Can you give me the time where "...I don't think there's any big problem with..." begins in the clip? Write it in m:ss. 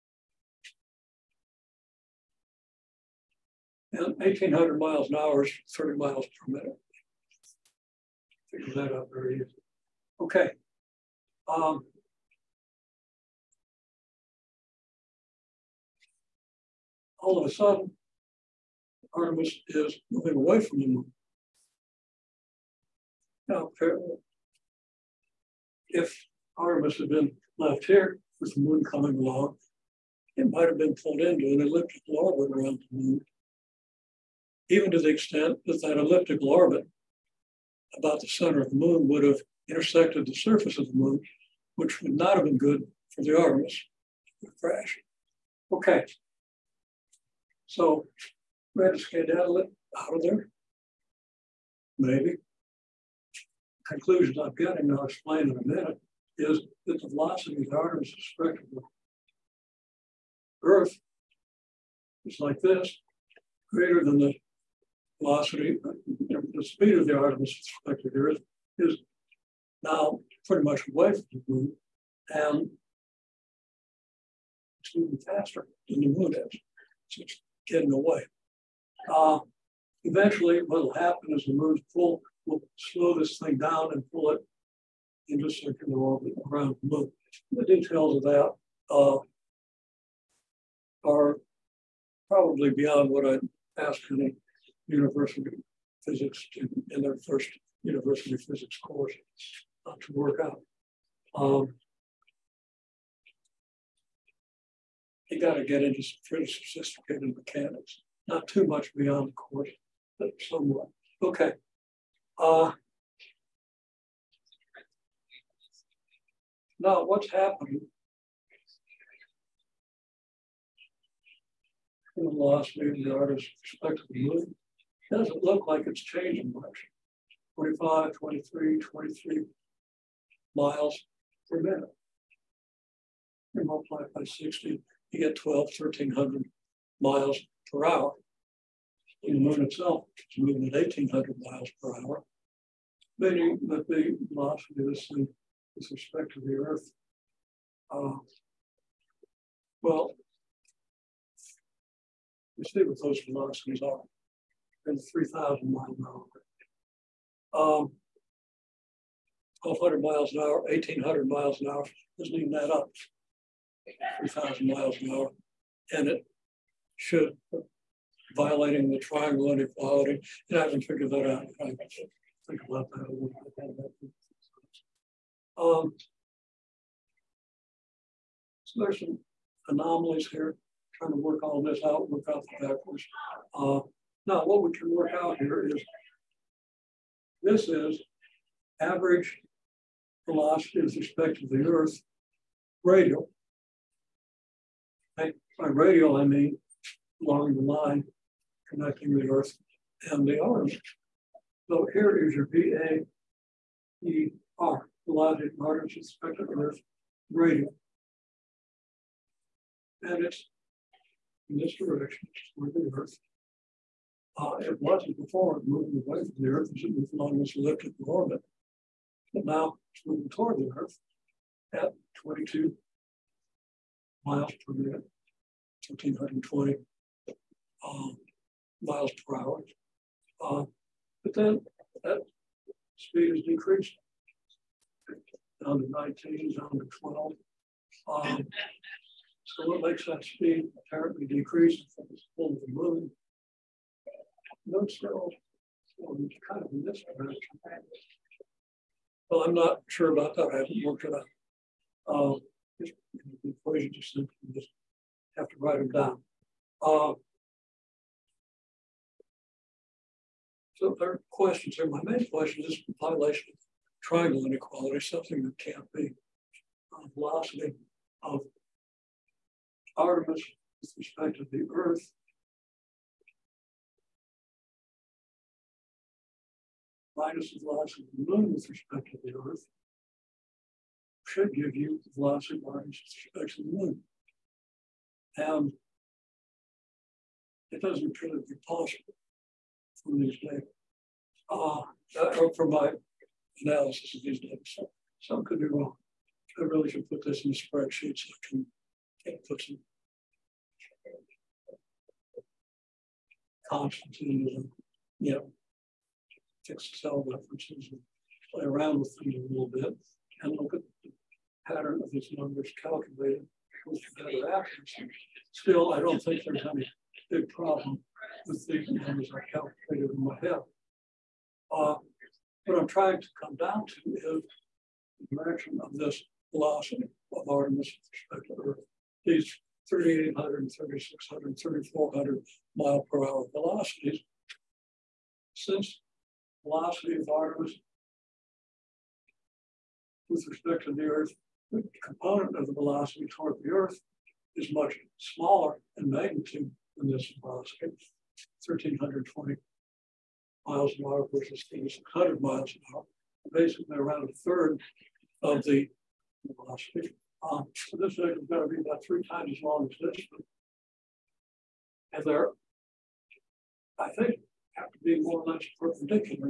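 5:15.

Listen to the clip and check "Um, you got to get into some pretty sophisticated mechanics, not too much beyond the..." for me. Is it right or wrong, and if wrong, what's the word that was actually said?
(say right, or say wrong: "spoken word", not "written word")
right.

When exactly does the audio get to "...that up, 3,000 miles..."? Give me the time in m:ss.
2:42.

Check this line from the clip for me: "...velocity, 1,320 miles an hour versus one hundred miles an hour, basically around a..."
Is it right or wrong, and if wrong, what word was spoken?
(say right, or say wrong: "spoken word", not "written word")
right.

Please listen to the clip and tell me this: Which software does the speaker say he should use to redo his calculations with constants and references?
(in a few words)
Excel.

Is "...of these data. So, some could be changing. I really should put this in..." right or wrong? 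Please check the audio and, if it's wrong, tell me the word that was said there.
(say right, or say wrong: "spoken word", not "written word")
wrong: "wrong", not "changing".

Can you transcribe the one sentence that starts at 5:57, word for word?
Um, so this thing is going to be about three times as long as this one.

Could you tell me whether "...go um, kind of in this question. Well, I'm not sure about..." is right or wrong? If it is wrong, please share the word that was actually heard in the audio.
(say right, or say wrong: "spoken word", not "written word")
wrong: "direction", not "question".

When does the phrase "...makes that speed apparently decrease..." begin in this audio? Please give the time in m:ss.
3:59.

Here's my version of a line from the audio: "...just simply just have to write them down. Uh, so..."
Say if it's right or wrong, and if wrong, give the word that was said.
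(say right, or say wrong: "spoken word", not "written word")
right.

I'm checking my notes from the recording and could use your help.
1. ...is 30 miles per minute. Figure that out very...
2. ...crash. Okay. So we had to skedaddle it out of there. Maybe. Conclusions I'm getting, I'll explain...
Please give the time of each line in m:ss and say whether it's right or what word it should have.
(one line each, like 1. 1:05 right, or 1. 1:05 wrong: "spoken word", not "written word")
1. 0:05 right
2. 0:44 right.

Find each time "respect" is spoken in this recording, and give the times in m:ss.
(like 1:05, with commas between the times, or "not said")
2:25, 3:10, 3:25, 4:30, 4:38, 4:43, 5:27, 5:40.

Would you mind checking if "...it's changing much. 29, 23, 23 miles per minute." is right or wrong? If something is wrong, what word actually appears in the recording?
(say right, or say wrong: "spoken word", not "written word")
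wrong: "25", not "29".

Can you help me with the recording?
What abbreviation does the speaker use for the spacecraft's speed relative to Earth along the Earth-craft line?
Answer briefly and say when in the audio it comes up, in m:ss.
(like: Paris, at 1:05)
VAER, at 3:22.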